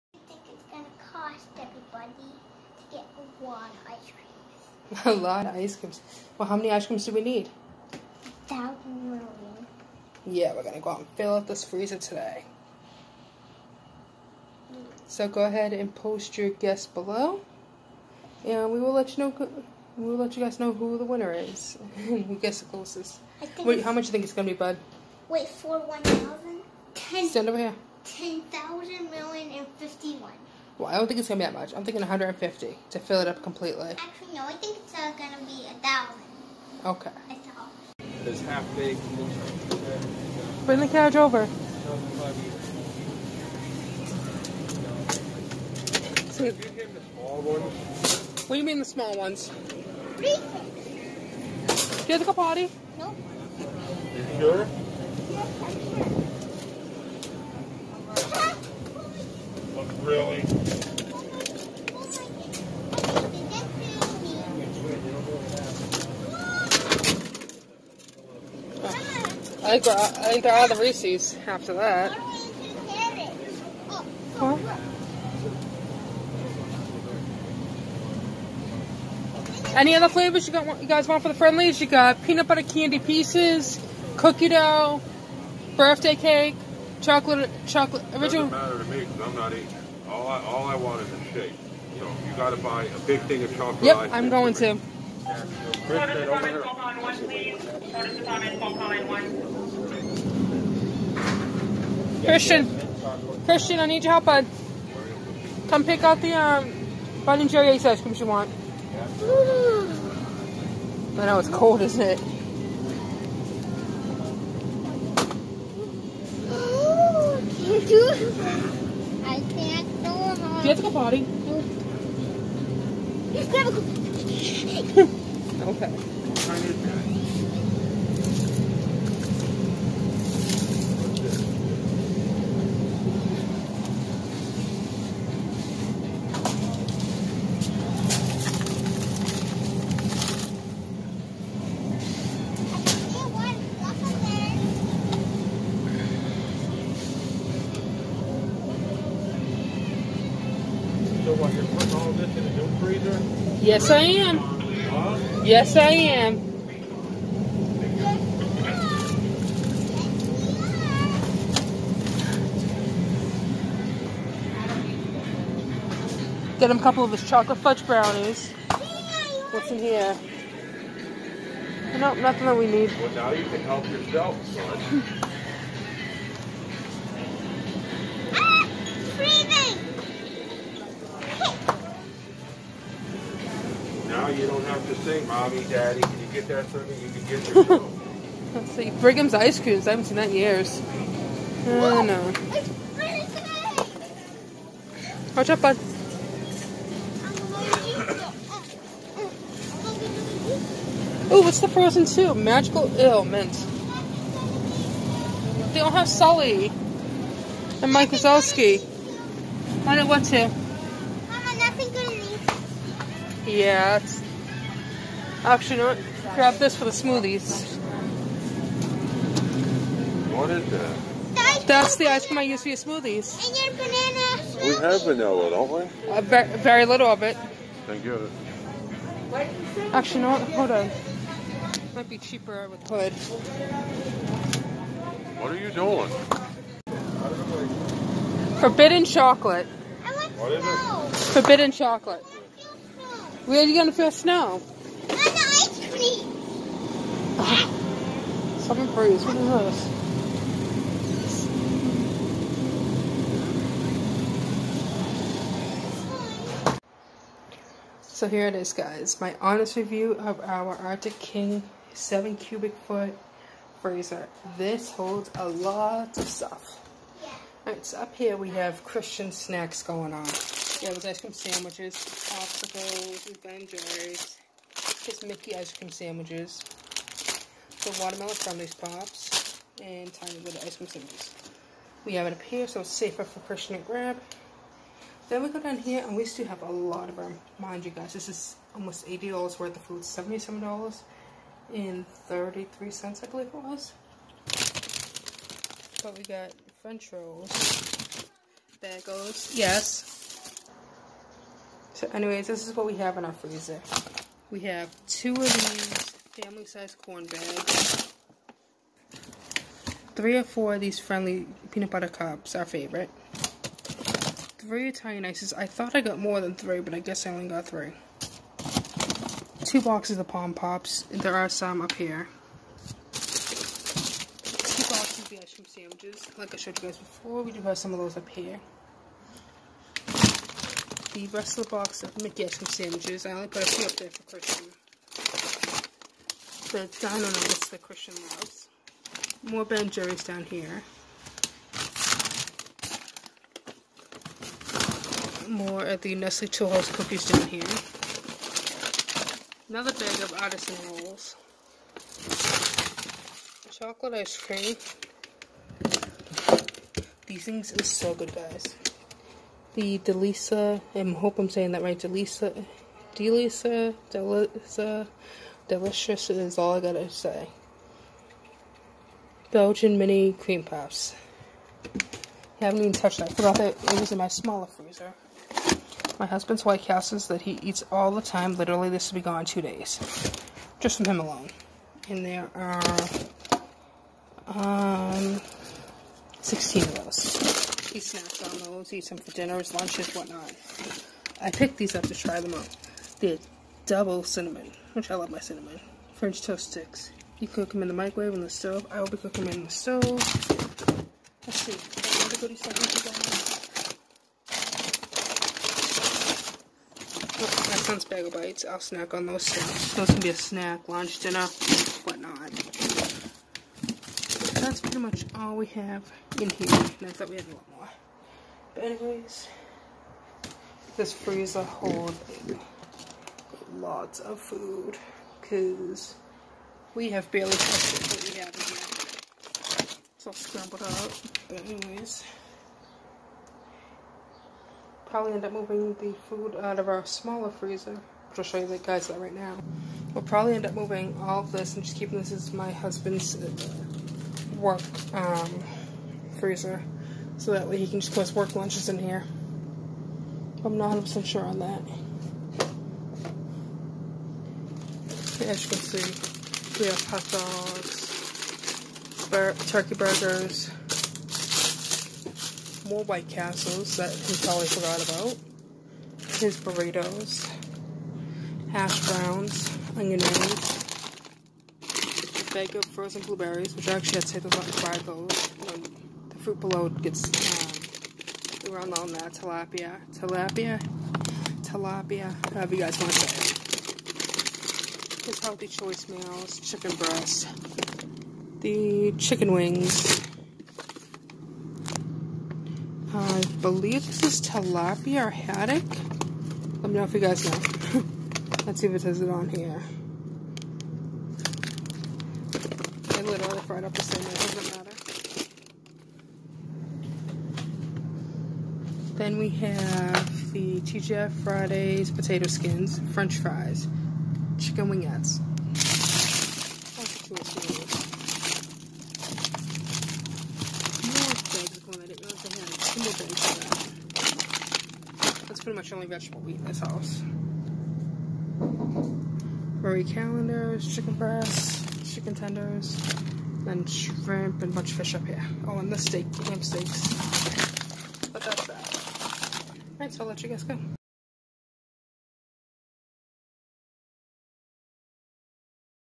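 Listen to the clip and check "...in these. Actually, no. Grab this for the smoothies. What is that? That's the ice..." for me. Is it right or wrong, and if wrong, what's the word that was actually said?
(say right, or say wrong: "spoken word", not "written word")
right.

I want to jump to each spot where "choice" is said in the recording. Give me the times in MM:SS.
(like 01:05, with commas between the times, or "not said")
08:05.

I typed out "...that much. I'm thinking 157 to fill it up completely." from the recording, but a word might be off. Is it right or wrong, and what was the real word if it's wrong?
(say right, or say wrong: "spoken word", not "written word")
wrong: "150", not "157".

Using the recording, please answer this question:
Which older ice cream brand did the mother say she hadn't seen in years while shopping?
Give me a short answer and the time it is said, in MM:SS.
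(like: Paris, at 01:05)
Brigham's, at 03:08.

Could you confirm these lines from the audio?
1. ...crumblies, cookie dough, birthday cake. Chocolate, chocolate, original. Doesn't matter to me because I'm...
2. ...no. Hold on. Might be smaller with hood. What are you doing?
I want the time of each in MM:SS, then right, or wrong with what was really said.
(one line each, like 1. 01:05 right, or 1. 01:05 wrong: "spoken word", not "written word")
1. 01:22 wrong: "pieces", not "crumblies"
2. 03:50 wrong: "cheaper", not "smaller".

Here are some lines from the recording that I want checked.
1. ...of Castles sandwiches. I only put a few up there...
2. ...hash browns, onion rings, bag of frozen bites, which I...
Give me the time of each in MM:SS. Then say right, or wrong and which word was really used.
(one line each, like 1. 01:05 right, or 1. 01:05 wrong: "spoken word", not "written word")
1. 05:32 wrong: "Mickey", not "Castles"
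2. 07:48 wrong: "blueberries", not "bites".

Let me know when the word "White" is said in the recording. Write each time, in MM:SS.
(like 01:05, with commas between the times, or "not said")
06:16, 07:43.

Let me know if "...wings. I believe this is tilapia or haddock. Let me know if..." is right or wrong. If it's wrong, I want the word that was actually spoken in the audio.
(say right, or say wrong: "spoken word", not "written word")
right.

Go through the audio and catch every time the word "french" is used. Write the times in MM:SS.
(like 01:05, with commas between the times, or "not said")
04:56, 06:36, 08:33.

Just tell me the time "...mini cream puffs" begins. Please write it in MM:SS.
06:09.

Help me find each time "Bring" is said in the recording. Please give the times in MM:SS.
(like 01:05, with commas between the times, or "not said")
00:40.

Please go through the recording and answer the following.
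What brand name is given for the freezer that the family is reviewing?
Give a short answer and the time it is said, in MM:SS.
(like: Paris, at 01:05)
Arctic King, at 04:20.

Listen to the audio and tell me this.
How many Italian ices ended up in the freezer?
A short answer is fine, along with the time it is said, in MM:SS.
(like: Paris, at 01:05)
3, at 05:14.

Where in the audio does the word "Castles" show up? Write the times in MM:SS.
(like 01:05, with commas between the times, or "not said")
06:16, 07:43.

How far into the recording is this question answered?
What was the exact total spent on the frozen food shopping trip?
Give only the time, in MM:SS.
04:50.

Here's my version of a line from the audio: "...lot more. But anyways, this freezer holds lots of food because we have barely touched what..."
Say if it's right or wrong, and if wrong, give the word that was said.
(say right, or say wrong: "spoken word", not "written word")
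right.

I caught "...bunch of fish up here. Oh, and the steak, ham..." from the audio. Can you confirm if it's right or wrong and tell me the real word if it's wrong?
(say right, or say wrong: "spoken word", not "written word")
right.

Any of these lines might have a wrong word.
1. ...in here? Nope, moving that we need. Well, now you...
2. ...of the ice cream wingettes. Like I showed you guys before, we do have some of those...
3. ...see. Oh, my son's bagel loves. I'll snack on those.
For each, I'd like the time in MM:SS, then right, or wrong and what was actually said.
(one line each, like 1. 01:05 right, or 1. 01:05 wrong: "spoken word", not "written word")
1. 02:49 wrong: "nothing", not "moving"
2. 05:25 wrong: "sandwiches", not "wingettes"
3. 06:41 wrong: "bites", not "loves".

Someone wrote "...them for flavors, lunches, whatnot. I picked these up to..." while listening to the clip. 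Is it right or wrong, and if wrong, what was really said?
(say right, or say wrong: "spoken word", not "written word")
wrong: "dinners", not "flavors".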